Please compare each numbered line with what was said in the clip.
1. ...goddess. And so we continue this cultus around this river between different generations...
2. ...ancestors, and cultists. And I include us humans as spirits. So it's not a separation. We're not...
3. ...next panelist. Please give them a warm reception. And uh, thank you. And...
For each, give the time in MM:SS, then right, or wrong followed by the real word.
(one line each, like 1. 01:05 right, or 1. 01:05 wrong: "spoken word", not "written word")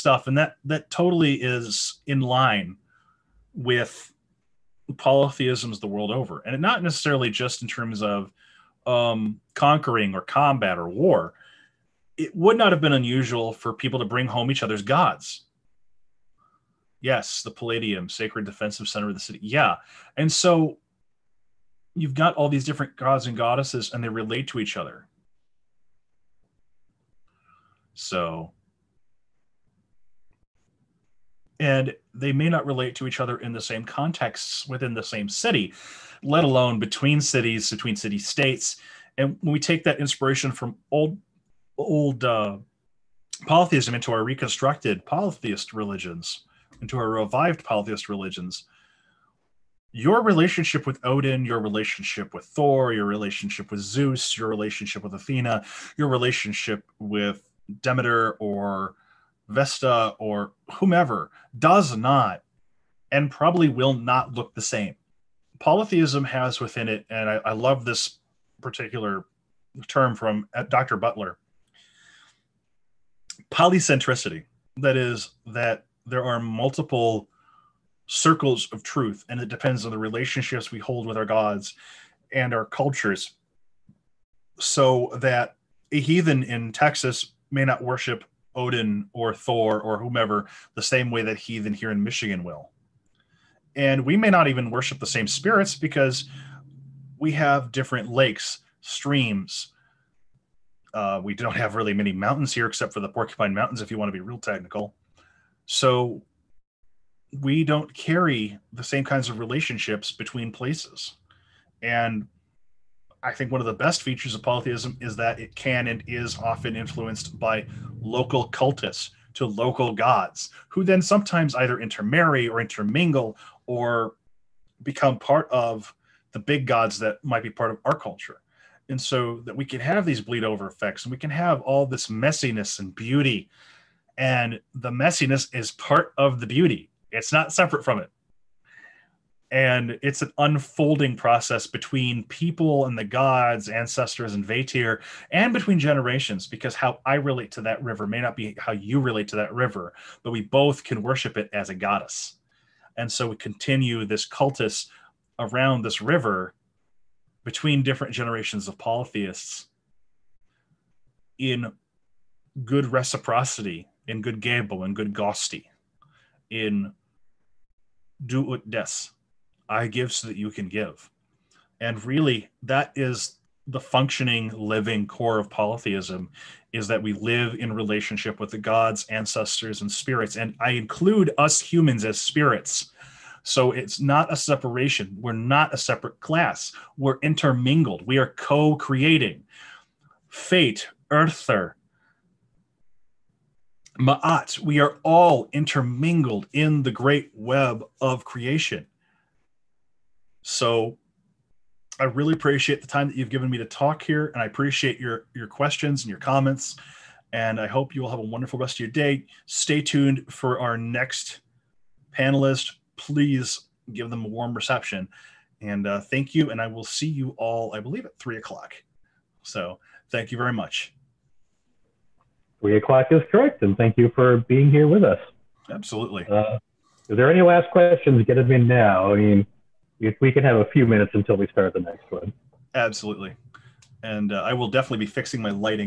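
1. 02:31 right
2. 02:59 wrong: "spirits", not "cultists"
3. 03:30 right.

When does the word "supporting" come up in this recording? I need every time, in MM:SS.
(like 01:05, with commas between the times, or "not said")
not said.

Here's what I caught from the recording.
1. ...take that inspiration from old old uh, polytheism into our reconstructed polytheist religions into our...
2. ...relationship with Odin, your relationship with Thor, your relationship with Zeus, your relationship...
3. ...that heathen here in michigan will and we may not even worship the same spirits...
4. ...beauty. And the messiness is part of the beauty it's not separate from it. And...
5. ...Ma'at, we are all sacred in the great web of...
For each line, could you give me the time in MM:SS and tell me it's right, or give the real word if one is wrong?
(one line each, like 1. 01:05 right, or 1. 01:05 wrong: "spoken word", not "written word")
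1. 00:39 right
2. 00:50 right
3. 01:31 right
4. 02:12 right
5. 03:13 wrong: "intermingled", not "sacred".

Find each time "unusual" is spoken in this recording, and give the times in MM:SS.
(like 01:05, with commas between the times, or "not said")
00:12.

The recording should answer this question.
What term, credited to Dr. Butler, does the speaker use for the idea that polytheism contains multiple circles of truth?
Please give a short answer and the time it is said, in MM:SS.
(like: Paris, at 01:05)
Polycentricity, at 01:13.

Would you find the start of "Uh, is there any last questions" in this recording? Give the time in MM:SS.
03:46.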